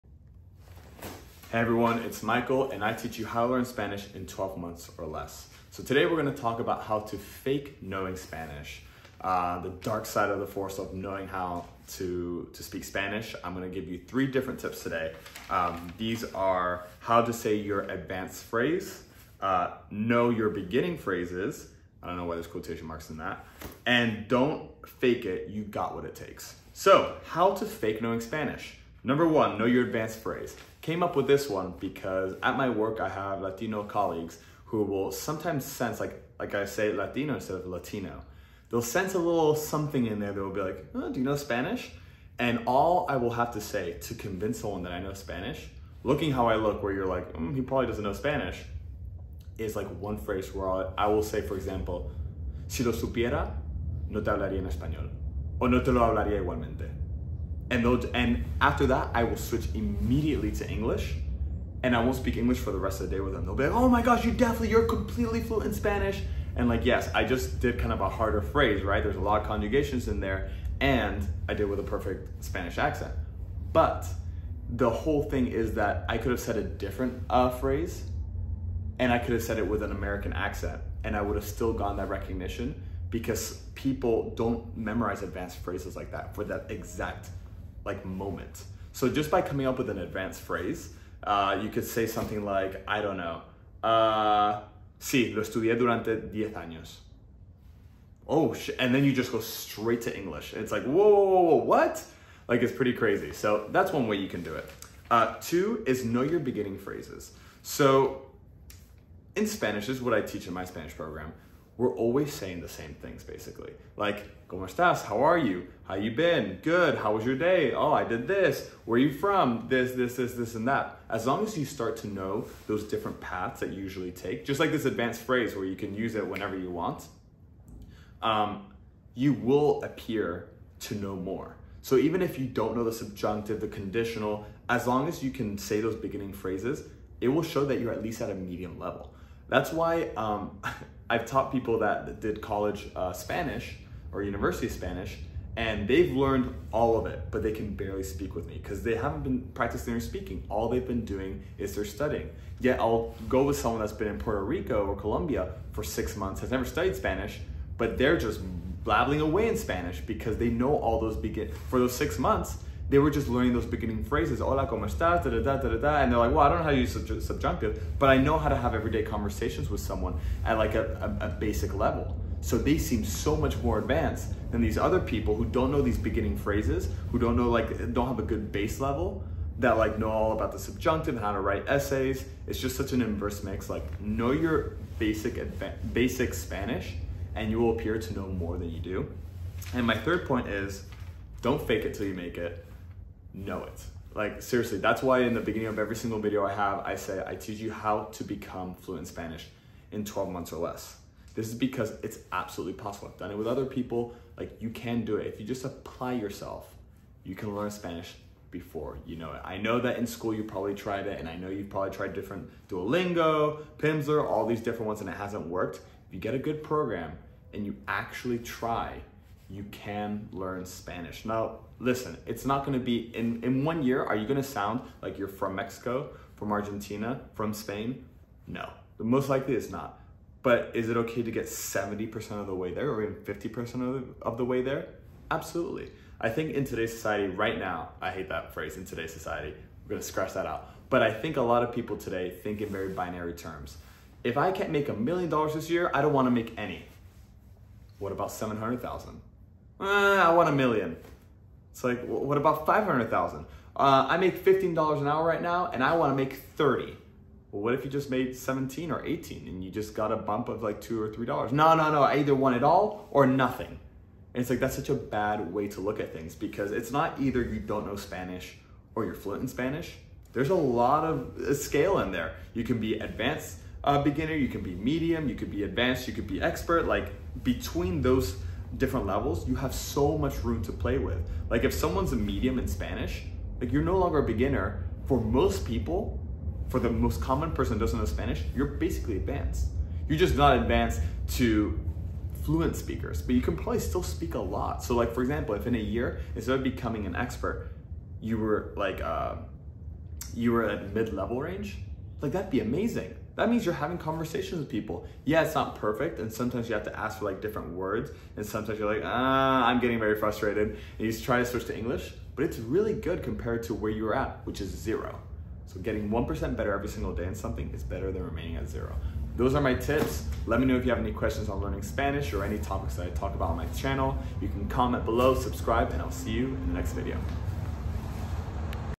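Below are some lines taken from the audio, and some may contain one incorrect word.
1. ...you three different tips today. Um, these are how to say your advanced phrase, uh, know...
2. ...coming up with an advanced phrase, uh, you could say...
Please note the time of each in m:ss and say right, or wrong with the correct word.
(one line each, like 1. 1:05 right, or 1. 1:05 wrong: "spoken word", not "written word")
1. 0:13 right
2. 1:29 right.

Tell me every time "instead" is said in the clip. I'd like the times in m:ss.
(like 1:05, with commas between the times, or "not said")
0:37, 4:56.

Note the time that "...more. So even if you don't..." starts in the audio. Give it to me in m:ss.
2:11.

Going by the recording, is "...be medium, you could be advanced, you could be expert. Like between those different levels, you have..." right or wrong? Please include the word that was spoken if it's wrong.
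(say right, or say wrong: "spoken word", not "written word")
right.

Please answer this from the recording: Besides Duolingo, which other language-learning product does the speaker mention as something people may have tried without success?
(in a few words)
Pimsleur.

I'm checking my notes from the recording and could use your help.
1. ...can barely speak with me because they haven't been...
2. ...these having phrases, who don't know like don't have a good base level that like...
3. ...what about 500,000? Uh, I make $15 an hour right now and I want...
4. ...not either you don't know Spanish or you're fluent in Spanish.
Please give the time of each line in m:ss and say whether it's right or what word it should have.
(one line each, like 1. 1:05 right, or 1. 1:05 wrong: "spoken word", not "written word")
1. 2:27 right
2. 2:55 wrong: "beginning", not "having"
3. 4:12 right
4. 4:26 right.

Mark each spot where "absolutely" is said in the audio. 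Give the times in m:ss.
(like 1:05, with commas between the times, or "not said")
3:22, 3:55.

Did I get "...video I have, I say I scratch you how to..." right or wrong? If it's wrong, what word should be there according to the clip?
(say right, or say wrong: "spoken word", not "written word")
wrong: "teach", not "scratch".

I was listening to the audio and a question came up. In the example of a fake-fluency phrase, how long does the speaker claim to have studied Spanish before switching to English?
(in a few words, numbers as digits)
10 years.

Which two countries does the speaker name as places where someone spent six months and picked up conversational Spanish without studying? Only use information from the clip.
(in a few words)
Puerto Rico or Colombia.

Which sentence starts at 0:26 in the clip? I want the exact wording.
So how to fake knowing Spanish.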